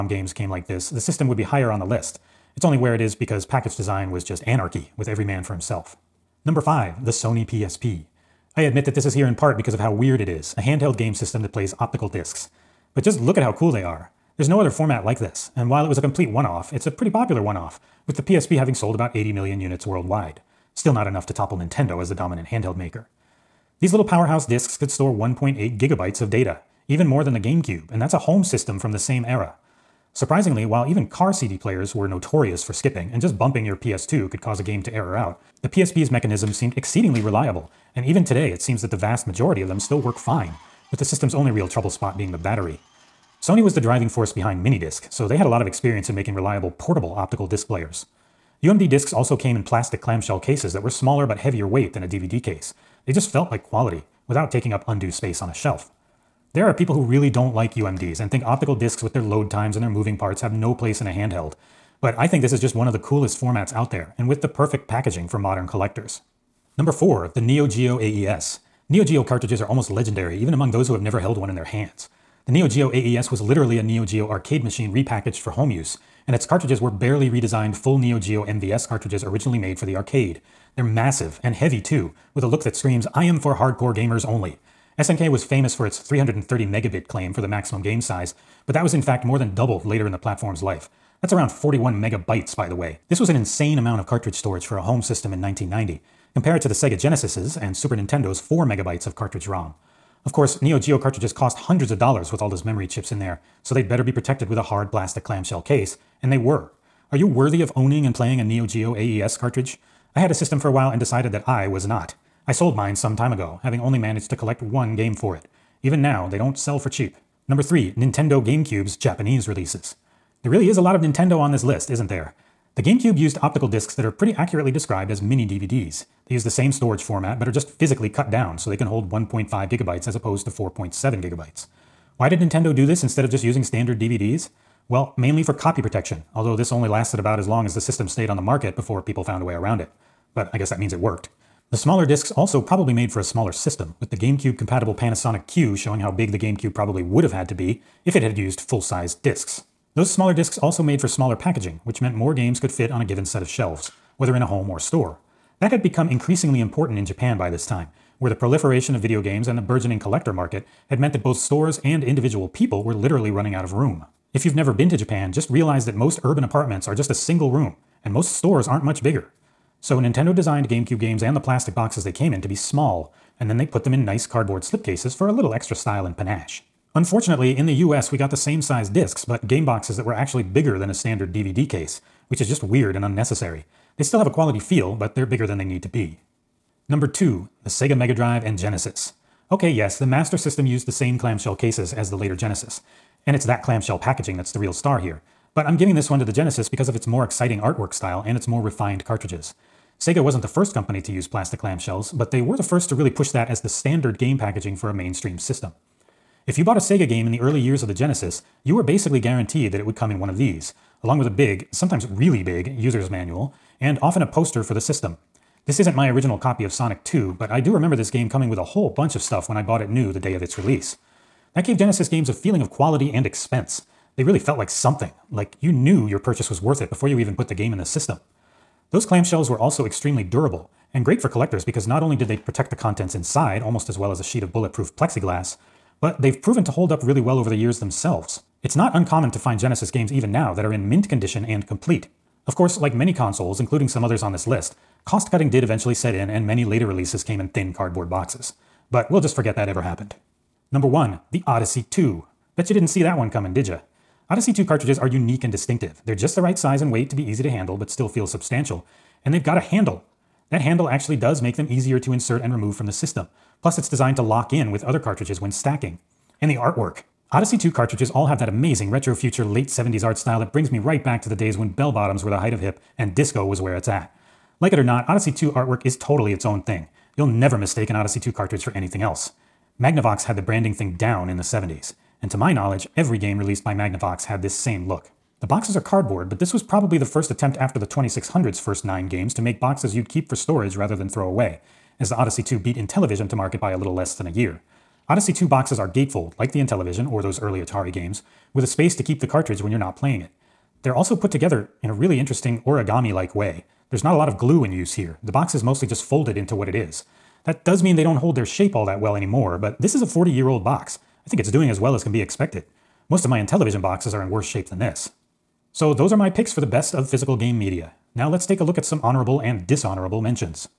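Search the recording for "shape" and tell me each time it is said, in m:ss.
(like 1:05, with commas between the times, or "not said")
5:08, 5:14.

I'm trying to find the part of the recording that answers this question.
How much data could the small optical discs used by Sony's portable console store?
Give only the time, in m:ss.
0:25.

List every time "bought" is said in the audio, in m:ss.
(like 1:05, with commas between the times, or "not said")
3:26, 3:39.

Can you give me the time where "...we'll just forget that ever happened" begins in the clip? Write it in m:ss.
4:09.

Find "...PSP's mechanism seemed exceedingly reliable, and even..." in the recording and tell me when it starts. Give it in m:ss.
0:35.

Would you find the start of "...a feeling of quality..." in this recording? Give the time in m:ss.
3:42.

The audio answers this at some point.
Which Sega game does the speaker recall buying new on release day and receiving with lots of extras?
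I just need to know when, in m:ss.
3:36.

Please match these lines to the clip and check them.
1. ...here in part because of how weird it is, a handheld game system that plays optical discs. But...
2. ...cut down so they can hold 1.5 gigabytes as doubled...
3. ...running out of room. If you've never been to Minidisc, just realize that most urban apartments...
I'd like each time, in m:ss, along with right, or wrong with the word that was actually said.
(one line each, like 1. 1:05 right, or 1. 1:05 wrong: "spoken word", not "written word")
1. 0:09 right
2. 2:08 wrong: "opposed", not "doubled"
3. 2:43 wrong: "Japan", not "Minidisc".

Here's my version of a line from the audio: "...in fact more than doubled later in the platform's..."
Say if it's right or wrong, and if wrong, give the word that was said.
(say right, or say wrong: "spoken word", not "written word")
right.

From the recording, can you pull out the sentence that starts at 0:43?
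Sony was the driving force behind Minidisc, so they had a lot of experience in making reliable portable optical disc players.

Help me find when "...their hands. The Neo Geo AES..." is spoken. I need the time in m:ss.
1:11.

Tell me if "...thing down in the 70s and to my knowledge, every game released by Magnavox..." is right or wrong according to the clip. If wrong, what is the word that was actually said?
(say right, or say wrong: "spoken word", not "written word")
right.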